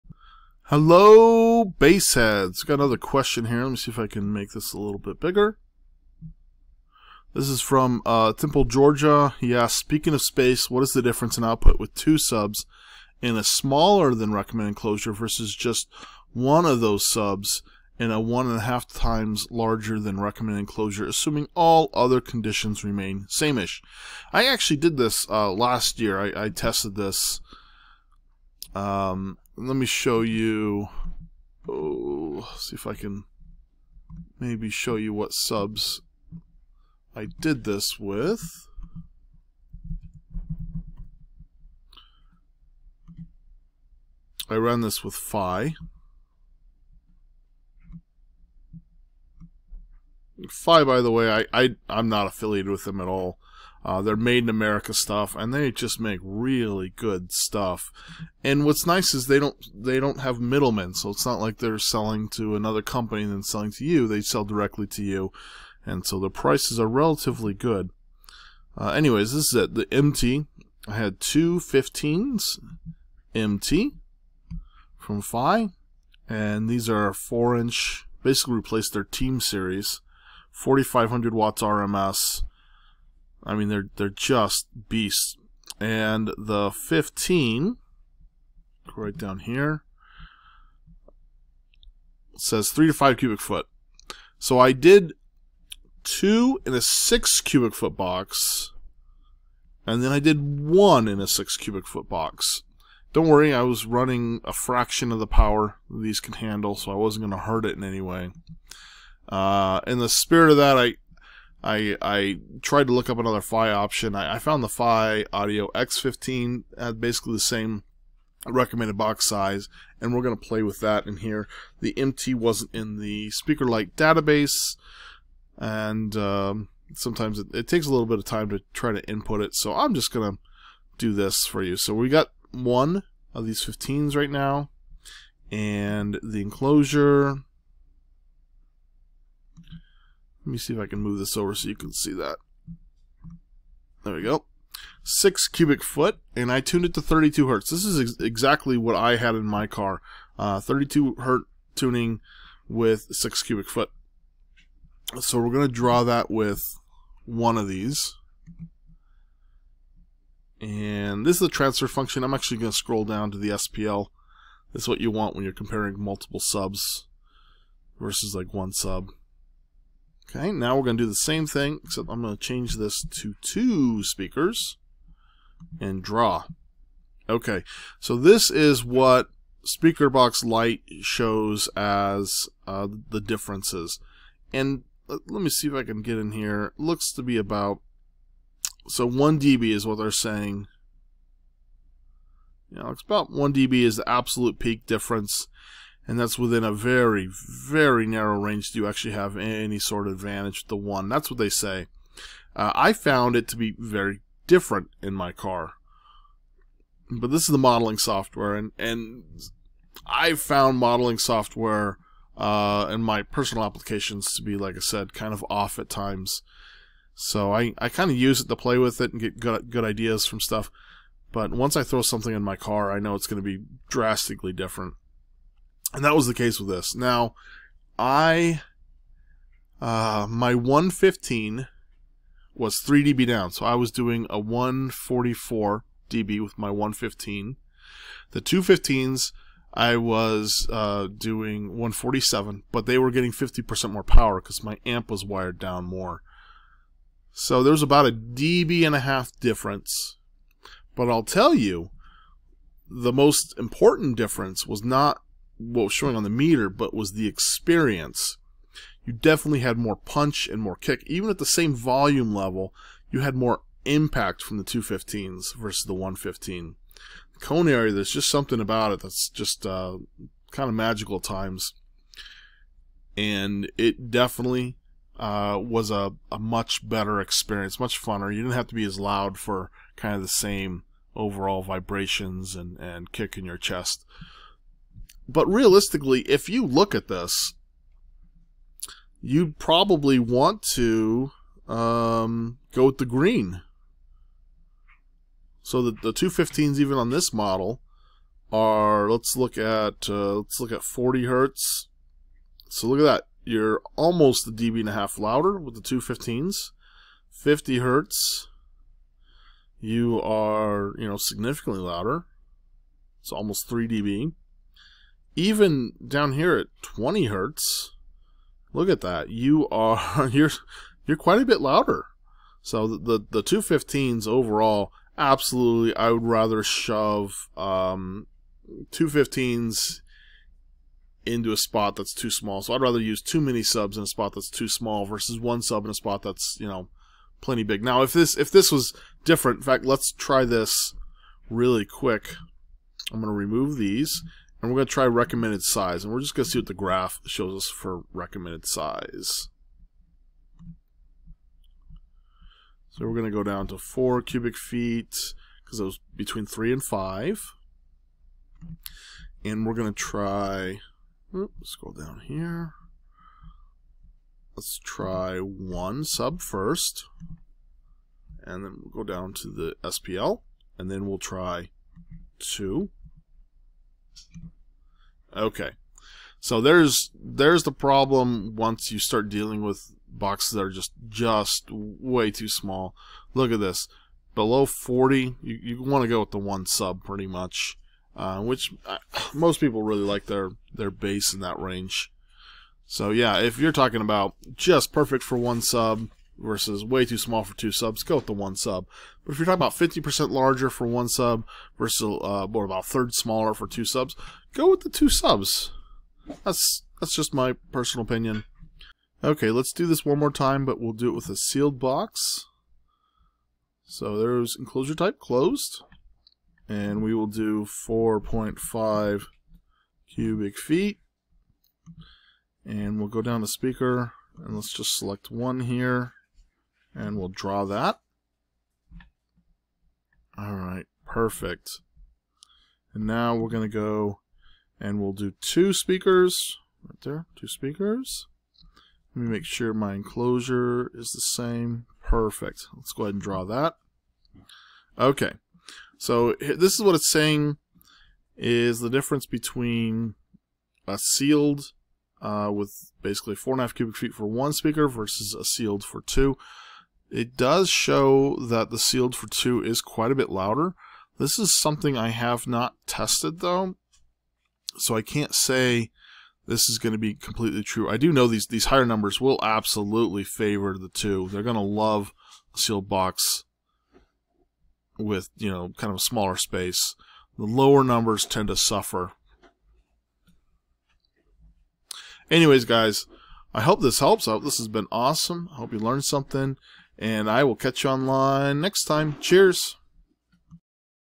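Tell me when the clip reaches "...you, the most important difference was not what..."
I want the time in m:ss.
4:11.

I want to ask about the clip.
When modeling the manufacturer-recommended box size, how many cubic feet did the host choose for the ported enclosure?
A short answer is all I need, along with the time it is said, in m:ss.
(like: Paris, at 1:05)
4, at 5:53.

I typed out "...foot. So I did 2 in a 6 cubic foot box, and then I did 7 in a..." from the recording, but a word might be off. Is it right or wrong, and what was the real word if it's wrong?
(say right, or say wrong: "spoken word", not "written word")
wrong: "1", not "7".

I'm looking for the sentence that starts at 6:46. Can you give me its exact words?
That's that's just my personal opinion.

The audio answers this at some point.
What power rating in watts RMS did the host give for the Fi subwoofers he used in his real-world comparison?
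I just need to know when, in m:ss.
1:20.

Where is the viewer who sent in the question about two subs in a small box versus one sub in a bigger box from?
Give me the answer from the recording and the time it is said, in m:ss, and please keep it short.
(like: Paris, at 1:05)
Temple, Georgia, at 0:08.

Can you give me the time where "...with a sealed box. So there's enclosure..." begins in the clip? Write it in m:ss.
6:51.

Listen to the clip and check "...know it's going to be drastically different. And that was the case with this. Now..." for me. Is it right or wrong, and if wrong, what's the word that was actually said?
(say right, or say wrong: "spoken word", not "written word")
right.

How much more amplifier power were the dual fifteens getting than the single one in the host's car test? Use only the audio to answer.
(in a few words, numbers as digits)
50%.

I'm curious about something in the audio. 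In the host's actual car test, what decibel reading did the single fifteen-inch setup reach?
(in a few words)
144 dB.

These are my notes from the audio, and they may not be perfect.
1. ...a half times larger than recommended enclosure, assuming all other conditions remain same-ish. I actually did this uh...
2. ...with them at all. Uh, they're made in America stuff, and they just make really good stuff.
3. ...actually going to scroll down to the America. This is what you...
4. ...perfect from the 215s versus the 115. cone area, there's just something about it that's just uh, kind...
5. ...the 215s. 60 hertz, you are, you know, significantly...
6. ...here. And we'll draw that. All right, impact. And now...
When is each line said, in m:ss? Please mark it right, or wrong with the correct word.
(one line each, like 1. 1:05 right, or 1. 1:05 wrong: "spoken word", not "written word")
1. 0:18 right
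2. 0:52 right
3. 2:42 wrong: "SPL", not "America"
4. 4:23 wrong: "impact", not "perfect"
5. 5:05 wrong: "50", not "60"
6. 7:05 wrong: "perfect", not "impact".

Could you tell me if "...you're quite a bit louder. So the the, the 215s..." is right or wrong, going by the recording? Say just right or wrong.
right.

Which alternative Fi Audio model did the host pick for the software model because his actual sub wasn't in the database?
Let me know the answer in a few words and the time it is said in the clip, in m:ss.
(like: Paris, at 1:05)
X15, at 1:54.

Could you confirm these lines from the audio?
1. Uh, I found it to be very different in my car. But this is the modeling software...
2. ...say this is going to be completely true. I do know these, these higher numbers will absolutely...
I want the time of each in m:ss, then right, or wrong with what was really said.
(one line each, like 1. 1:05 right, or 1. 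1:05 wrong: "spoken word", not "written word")
1. 3:22 right
2. 7:45 right.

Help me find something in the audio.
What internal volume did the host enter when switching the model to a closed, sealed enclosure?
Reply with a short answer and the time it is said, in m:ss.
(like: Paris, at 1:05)
4.5 cubic feet, at 6:57.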